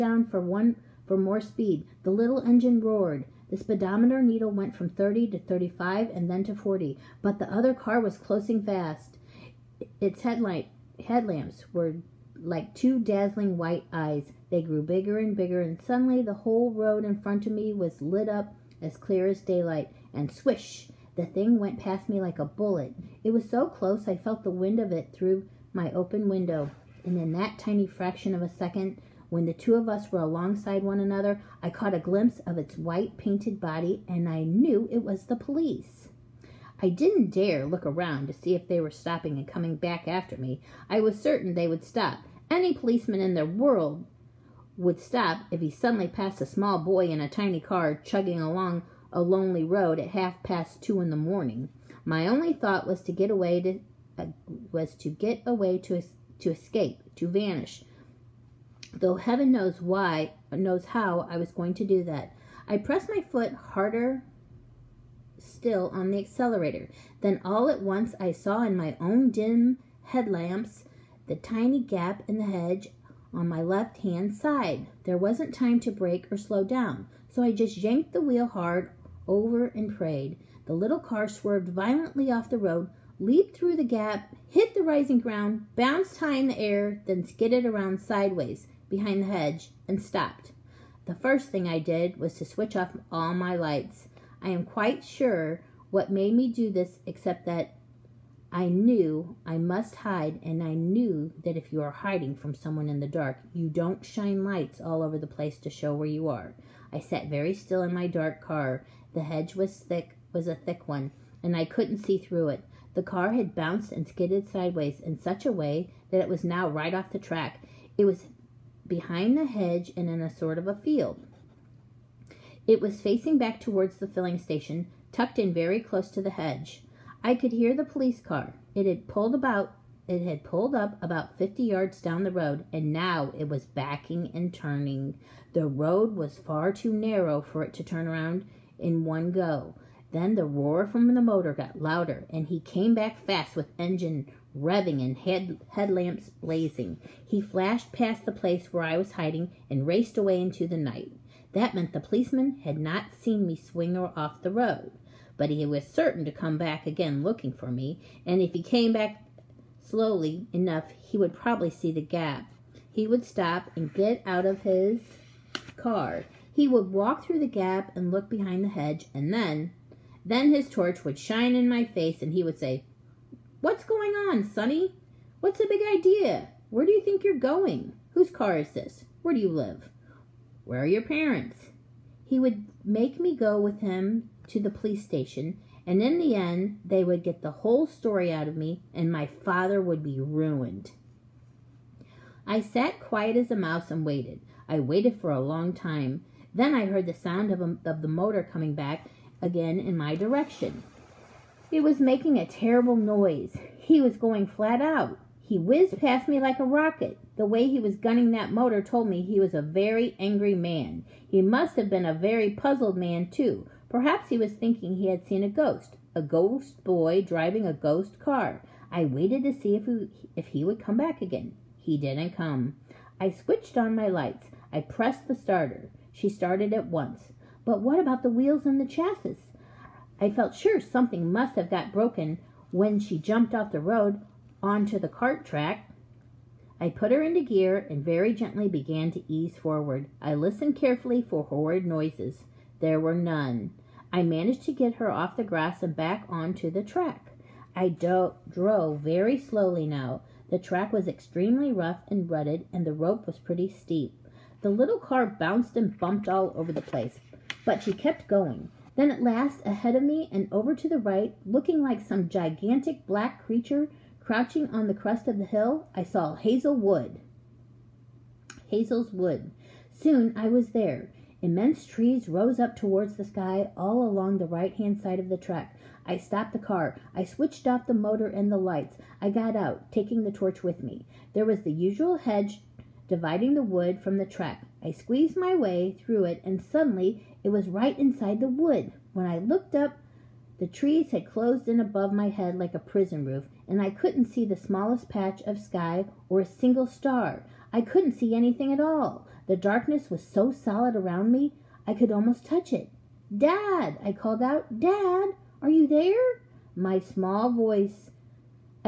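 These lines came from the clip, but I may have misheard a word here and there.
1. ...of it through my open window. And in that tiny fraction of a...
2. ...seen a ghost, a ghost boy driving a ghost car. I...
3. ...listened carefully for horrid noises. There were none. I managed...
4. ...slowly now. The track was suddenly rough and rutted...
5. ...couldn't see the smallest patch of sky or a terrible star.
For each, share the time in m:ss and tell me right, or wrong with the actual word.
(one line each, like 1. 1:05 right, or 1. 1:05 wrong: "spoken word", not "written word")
1. 0:24 right
2. 3:35 right
3. 4:00 right
4. 4:09 wrong: "extremely", not "suddenly"
5. 4:53 wrong: "single", not "terrible".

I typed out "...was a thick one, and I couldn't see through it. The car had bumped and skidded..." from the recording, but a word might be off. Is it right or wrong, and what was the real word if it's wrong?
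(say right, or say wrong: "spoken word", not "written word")
wrong: "bounced", not "bumped".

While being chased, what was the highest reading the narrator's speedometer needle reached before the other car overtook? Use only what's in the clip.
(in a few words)
40.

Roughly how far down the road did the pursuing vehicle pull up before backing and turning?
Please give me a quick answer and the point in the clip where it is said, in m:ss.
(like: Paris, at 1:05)
50 yards, at 2:11.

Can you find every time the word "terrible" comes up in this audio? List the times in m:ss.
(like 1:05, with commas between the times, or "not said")
3:22.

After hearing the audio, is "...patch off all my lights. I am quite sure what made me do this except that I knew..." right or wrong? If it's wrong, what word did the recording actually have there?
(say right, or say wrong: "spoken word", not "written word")
wrong: "switch", not "patch".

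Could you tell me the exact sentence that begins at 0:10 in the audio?
Its headlight headlamps were like two dazzling white eyes.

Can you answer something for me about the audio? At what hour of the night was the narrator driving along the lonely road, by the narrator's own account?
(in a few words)
2:30 in the morning.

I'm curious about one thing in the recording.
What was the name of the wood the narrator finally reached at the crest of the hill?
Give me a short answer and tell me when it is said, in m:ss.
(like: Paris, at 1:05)
Hazell's Wood, at 4:28.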